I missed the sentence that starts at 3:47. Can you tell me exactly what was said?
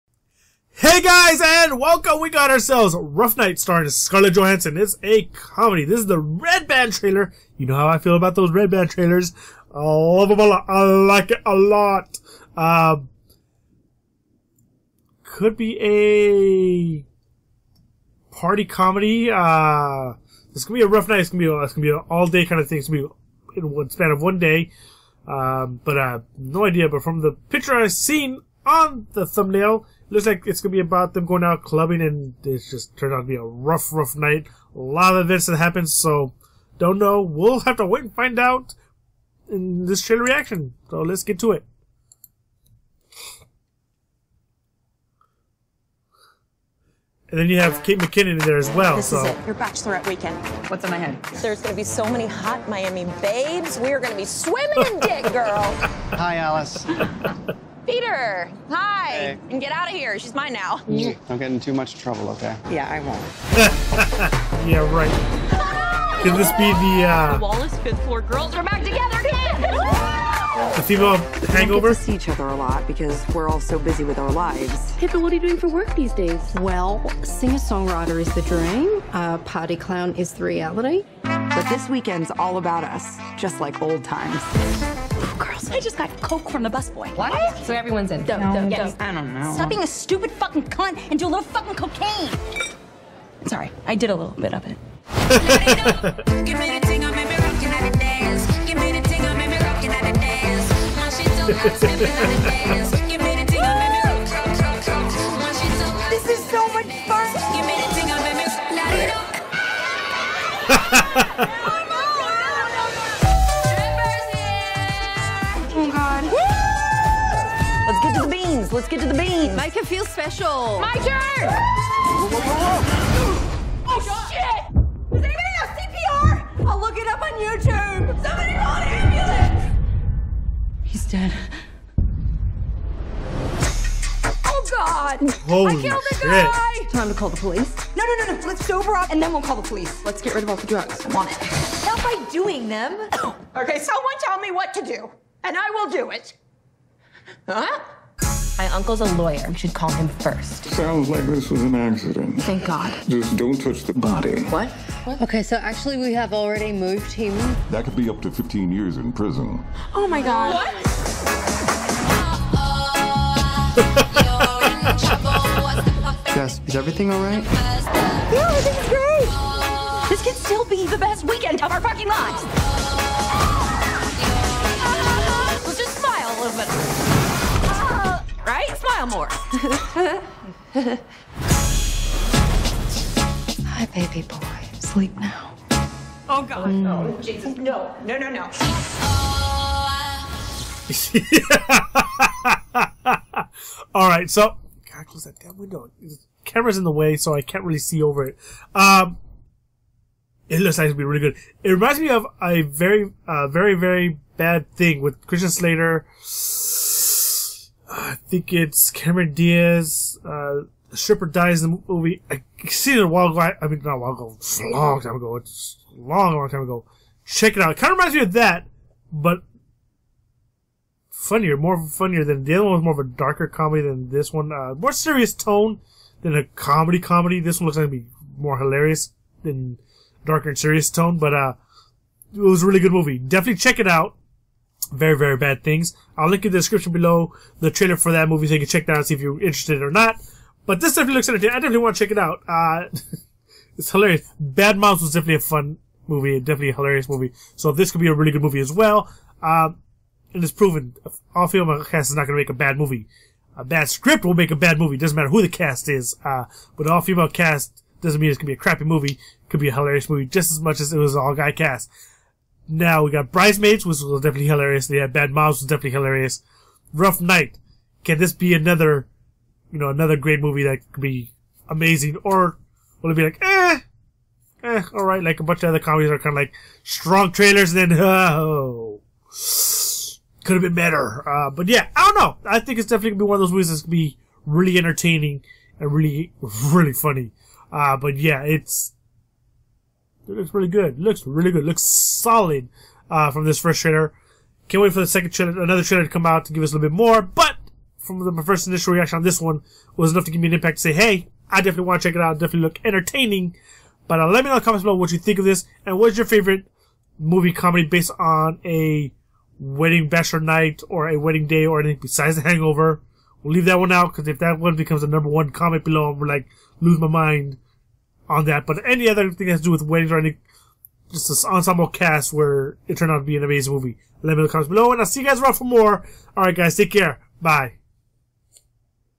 This one looks like to be more hilarious than darker and serious tone, but uh, it was a really good movie.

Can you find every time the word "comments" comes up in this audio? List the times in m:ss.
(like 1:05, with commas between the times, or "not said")
5:04, 5:15, 5:24.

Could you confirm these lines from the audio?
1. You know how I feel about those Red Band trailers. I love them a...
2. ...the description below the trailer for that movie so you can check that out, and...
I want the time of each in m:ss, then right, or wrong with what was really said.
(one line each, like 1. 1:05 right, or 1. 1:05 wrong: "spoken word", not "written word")
1. 0:07 right
2. 3:56 right.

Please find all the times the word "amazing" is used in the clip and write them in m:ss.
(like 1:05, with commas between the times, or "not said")
4:31, 5:23.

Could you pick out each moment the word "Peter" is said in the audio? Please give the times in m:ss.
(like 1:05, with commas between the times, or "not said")
0:57.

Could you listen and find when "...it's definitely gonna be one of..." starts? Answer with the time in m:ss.
4:42.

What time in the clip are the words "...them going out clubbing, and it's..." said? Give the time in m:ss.
0:31.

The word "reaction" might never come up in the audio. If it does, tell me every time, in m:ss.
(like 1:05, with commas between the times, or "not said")
0:40, 4:58.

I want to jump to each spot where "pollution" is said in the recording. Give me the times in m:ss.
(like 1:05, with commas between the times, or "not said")
not said.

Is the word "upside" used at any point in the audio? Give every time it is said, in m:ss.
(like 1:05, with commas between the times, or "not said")
not said.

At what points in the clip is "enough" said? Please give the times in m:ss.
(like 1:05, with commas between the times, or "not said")
5:00.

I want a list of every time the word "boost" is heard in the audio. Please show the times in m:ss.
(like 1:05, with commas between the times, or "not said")
not said.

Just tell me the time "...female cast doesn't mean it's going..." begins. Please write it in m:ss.
4:17.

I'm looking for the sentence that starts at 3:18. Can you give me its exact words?
Um, it looks like it'd be really good.